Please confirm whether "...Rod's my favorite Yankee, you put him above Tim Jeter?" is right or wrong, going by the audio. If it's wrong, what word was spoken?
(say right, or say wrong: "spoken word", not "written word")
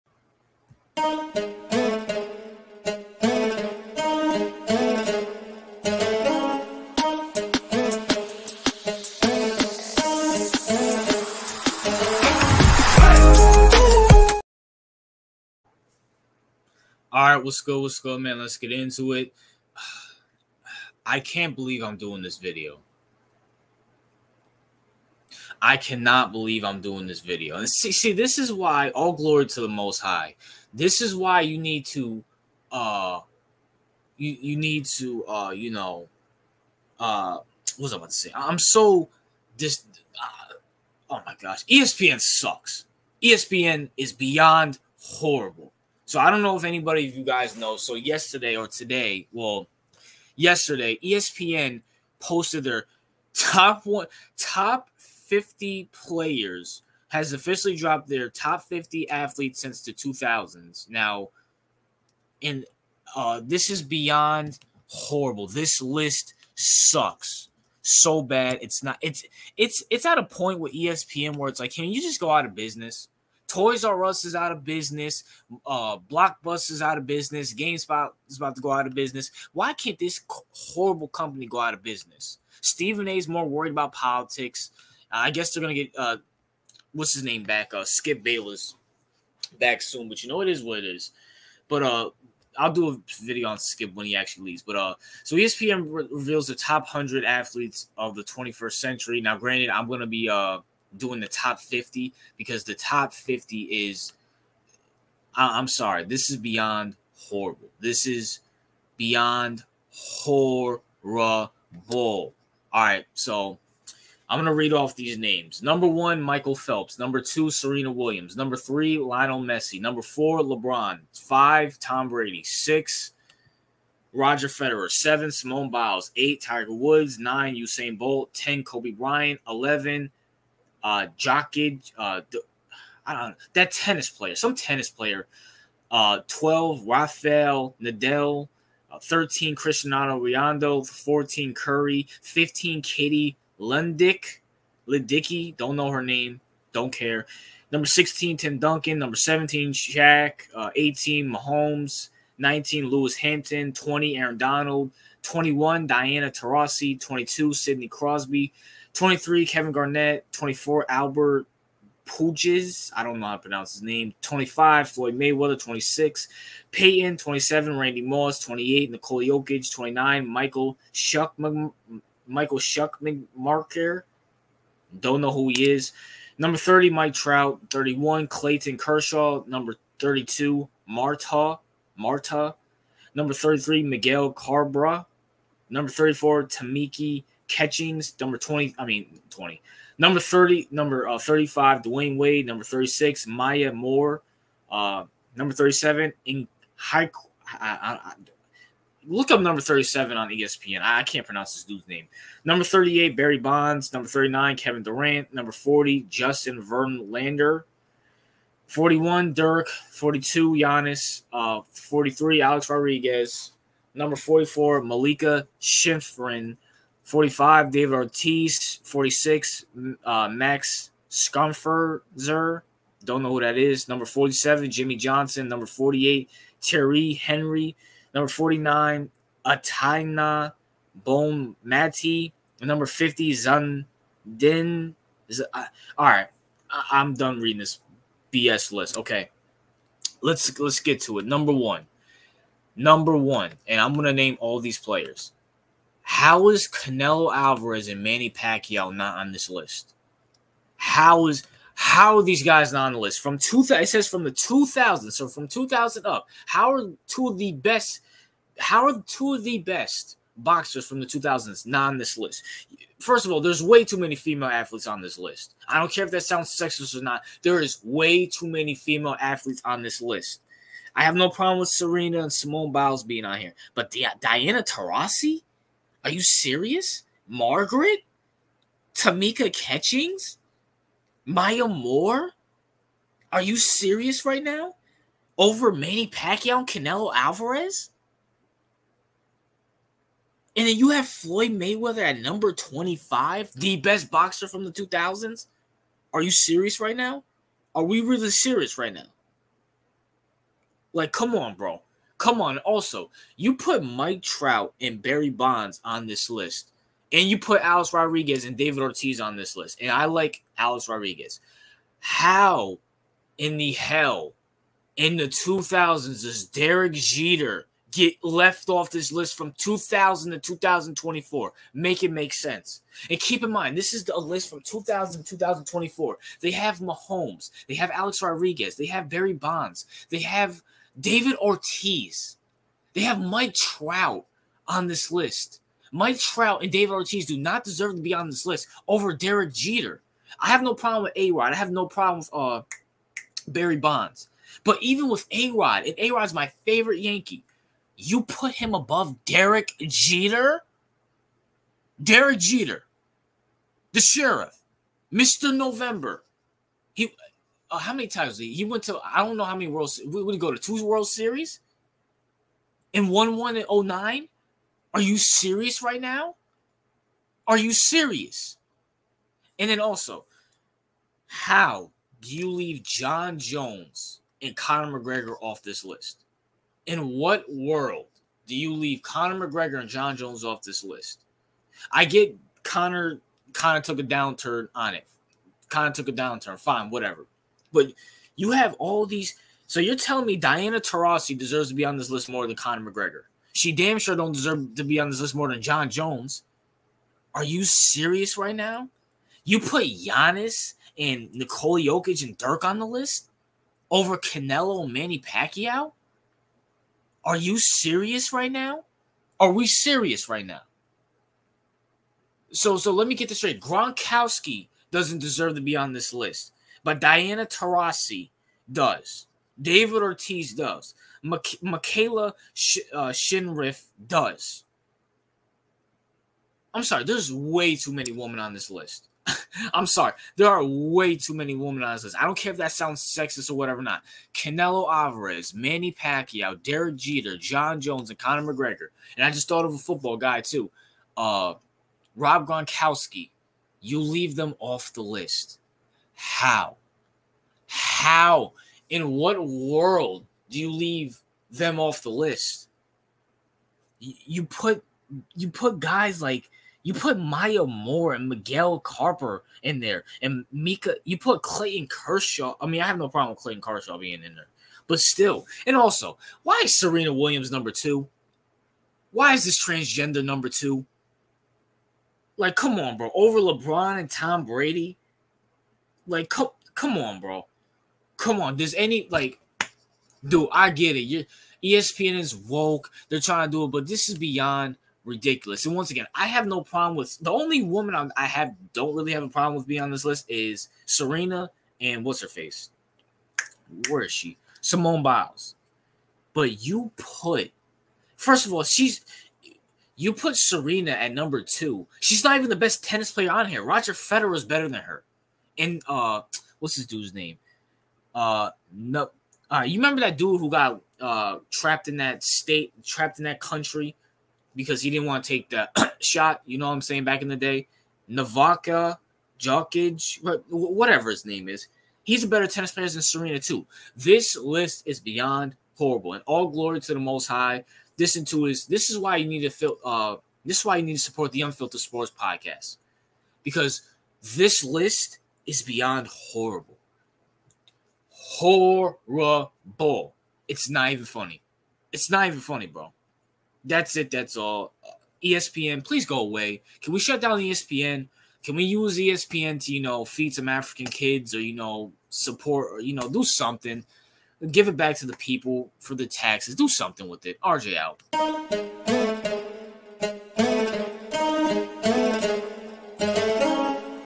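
wrong: "Derek", not "Tim".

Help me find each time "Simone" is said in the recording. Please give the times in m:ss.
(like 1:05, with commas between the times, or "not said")
2:05, 4:32, 8:14.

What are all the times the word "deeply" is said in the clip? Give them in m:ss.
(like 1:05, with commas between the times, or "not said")
not said.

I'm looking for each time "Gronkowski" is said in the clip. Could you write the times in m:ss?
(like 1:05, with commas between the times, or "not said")
6:53, 7:22.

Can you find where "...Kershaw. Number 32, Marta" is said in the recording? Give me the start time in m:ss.
2:58.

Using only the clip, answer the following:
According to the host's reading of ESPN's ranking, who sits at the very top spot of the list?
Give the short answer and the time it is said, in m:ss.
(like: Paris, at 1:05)
Michael Phelps, at 1:56.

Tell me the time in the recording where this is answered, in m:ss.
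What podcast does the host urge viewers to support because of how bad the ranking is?
8:51.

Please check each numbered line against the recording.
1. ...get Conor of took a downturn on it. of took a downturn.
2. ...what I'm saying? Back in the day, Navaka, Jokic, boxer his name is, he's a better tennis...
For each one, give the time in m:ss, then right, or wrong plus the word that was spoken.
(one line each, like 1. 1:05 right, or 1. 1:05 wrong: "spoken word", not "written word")
1. 6:22 right
2. 8:36 wrong: "whatever", not "boxer".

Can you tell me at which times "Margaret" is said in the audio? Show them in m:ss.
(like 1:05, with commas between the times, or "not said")
4:37.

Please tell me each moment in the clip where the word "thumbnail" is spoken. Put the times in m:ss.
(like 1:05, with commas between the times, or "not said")
not said.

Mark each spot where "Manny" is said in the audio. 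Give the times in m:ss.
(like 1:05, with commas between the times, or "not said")
4:08, 4:45, 6:44, 7:15.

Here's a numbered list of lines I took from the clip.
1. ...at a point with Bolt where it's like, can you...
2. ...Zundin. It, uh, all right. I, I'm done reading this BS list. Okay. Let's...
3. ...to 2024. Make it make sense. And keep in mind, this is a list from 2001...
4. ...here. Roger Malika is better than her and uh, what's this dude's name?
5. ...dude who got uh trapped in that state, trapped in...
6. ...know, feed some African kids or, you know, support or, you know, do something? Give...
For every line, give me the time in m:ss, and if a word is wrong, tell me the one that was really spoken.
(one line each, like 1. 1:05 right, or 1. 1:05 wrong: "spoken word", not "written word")
1. 1:10 wrong: "ESPN", not "Bolt"
2. 3:53 right
3. 5:20 wrong: "2000", not "2001"
4. 8:23 wrong: "Federer", not "Malika"
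5. 8:30 right
6. 9:09 right.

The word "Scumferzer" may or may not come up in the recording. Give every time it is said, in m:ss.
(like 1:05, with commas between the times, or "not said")
3:41.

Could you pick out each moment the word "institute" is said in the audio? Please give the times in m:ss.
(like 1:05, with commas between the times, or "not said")
not said.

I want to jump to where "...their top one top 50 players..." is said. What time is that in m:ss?
0:52.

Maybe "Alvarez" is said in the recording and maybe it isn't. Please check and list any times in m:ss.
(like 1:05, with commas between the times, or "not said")
4:07, 4:47, 7:14.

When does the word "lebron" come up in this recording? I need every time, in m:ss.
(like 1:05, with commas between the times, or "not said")
2:00, 7:53.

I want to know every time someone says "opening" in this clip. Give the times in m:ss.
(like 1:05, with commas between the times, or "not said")
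not said.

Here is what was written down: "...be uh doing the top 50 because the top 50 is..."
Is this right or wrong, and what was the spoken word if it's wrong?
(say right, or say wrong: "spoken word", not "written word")
right.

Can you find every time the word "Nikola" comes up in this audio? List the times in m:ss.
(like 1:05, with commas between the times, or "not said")
2:48, 6:41.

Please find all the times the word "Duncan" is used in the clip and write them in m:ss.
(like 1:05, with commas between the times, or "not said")
2:28.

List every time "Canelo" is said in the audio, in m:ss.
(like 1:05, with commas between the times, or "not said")
4:06, 4:46, 6:44, 7:14.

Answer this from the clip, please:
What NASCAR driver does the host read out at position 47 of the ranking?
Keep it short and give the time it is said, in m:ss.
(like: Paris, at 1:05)
Jimmie Johnson, at 3:44.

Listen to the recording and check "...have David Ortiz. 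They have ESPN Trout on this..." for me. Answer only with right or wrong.
wrong.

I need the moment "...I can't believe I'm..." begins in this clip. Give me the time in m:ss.
0:21.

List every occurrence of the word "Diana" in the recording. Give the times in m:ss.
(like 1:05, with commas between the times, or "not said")
2:35, 4:34, 6:30, 6:56.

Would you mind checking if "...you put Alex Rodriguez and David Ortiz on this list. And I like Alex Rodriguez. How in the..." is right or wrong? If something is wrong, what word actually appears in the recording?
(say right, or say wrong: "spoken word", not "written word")
right.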